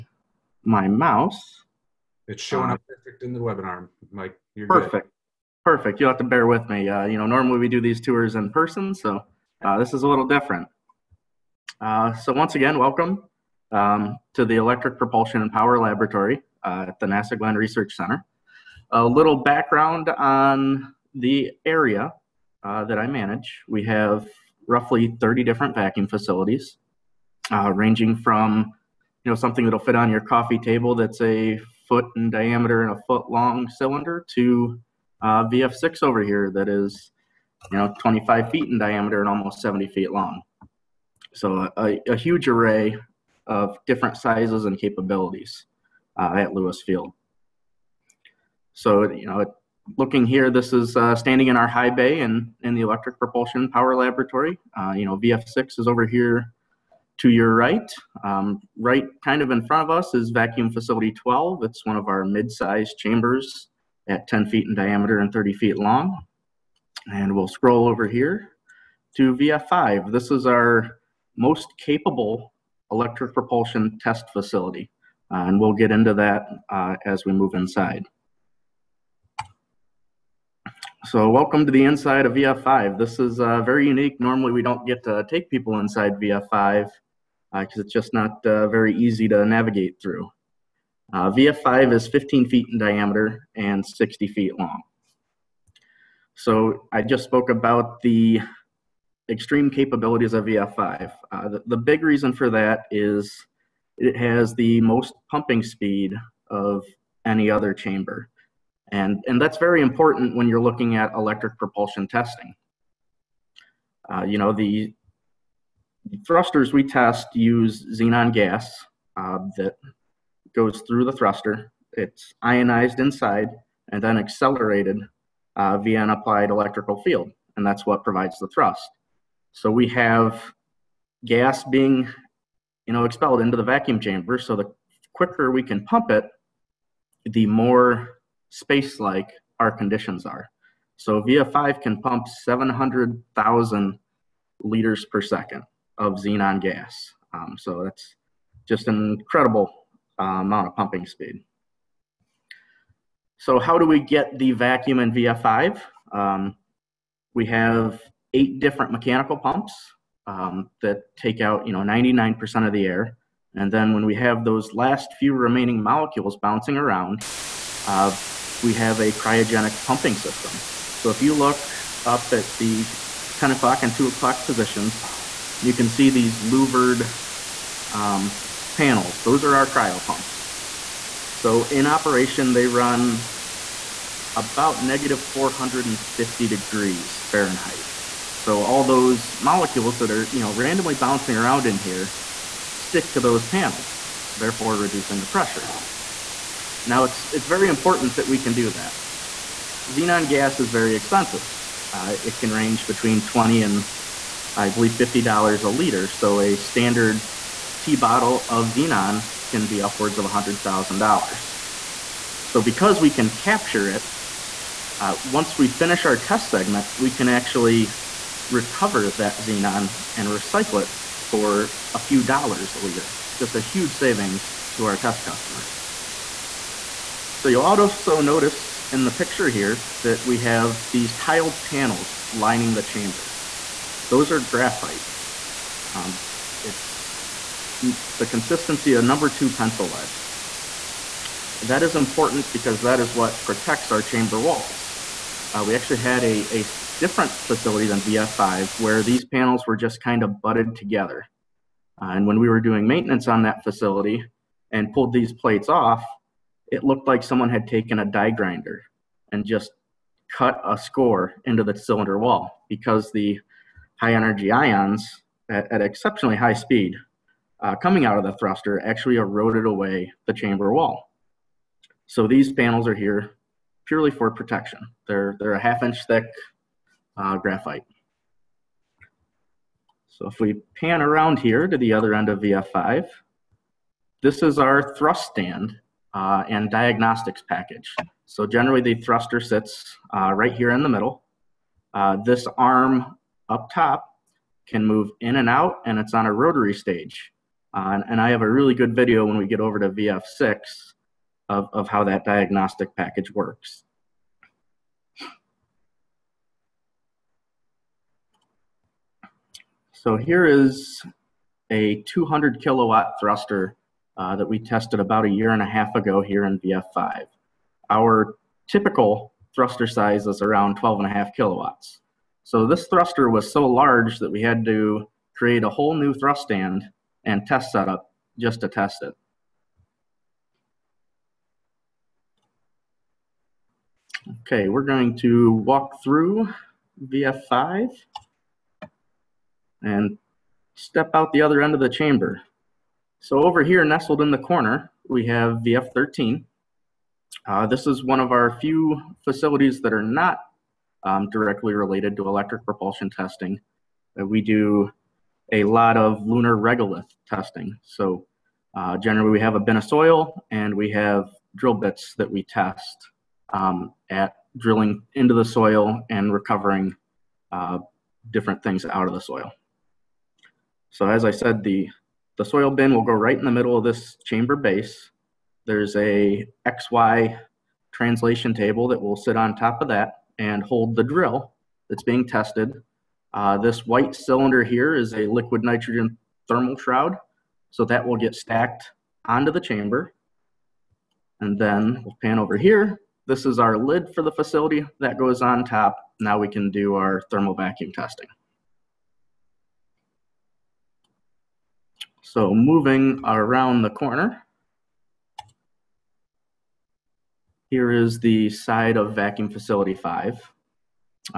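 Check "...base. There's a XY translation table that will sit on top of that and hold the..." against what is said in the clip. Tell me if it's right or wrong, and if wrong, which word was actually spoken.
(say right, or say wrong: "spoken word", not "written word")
right.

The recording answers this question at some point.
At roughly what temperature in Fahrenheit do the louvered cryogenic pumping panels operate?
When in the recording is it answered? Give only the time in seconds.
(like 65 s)
184 s.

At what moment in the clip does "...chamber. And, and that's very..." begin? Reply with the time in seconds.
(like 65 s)
107 s.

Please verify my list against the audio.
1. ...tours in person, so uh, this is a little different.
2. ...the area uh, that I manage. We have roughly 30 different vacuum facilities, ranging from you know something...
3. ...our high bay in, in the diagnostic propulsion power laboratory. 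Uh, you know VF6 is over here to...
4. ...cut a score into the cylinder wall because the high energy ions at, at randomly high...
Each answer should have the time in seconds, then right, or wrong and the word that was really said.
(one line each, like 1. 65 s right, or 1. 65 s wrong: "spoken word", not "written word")
1. 7 s right
2. 21 s right
3. 51 s wrong: "electric", not "diagnostic"
4. 260 s wrong: "exceptionally", not "randomly".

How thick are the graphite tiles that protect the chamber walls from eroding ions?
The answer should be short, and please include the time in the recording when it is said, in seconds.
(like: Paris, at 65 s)
half inch, at 275 s.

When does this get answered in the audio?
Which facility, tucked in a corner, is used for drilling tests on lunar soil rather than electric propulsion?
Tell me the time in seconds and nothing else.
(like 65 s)
345 s.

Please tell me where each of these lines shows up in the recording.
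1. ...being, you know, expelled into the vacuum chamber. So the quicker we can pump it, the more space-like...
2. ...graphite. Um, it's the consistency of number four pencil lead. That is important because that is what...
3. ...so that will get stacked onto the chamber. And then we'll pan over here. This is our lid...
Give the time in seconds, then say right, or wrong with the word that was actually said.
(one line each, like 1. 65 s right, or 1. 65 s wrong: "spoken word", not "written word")
1. 131 s right
2. 234 s wrong: "two", not "four"
3. 387 s right.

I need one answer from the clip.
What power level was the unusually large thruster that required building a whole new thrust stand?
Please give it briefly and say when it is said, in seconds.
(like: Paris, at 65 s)
200 kilowatts, at 312 s.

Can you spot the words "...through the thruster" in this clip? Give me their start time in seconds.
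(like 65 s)
120 s.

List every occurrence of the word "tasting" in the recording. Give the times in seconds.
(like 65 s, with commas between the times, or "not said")
not said.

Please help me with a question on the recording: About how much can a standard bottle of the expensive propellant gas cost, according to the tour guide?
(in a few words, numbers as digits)
$100,000.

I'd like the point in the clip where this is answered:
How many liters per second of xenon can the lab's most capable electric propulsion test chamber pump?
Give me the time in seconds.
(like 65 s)
142 s.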